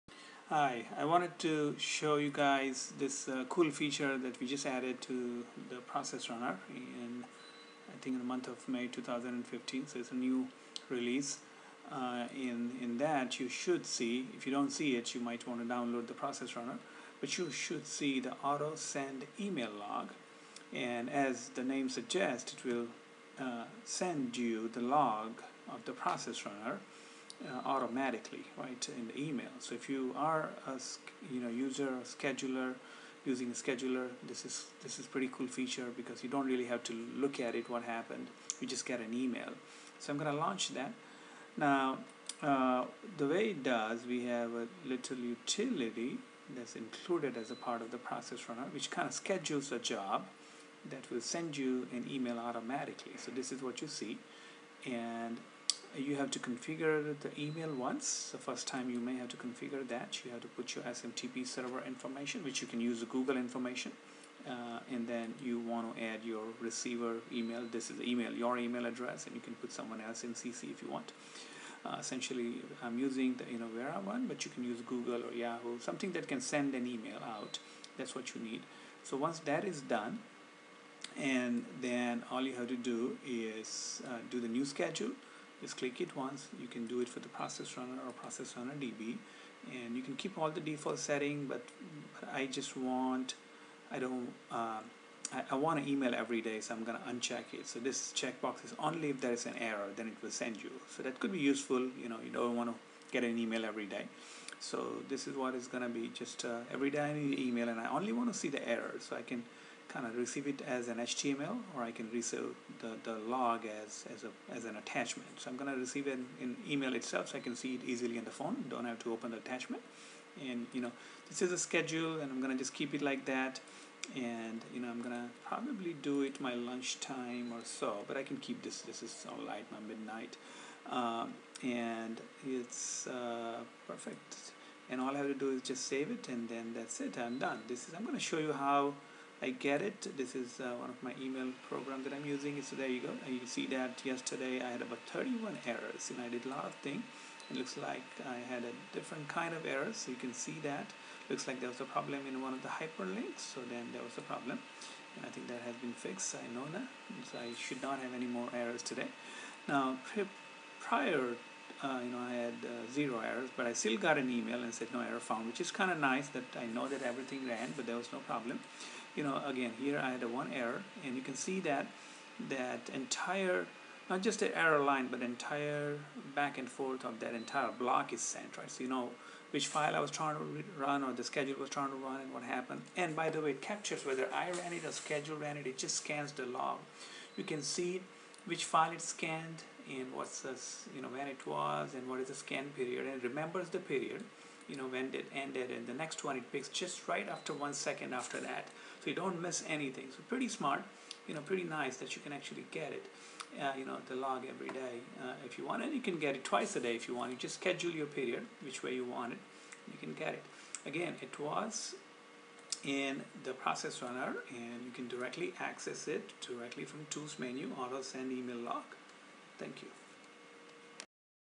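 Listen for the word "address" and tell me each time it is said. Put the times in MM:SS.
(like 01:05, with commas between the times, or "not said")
01:08.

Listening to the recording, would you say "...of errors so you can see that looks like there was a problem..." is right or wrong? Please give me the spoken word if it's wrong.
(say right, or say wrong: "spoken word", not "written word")
right.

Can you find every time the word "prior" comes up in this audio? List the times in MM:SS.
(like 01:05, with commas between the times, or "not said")
02:40.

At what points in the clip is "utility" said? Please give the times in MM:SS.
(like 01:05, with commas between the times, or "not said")
00:45.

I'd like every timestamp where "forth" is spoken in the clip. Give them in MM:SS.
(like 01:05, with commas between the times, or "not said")
02:56.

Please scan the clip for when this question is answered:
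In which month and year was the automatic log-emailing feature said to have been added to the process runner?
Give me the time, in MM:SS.
00:08.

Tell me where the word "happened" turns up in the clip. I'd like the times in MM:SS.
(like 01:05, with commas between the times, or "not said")
00:37, 03:02.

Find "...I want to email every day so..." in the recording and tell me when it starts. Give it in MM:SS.
01:35.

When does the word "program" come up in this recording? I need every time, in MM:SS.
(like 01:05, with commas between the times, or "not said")
02:21.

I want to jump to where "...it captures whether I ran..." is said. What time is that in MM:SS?
03:03.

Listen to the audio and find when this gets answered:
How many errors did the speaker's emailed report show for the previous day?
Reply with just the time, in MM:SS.
02:25.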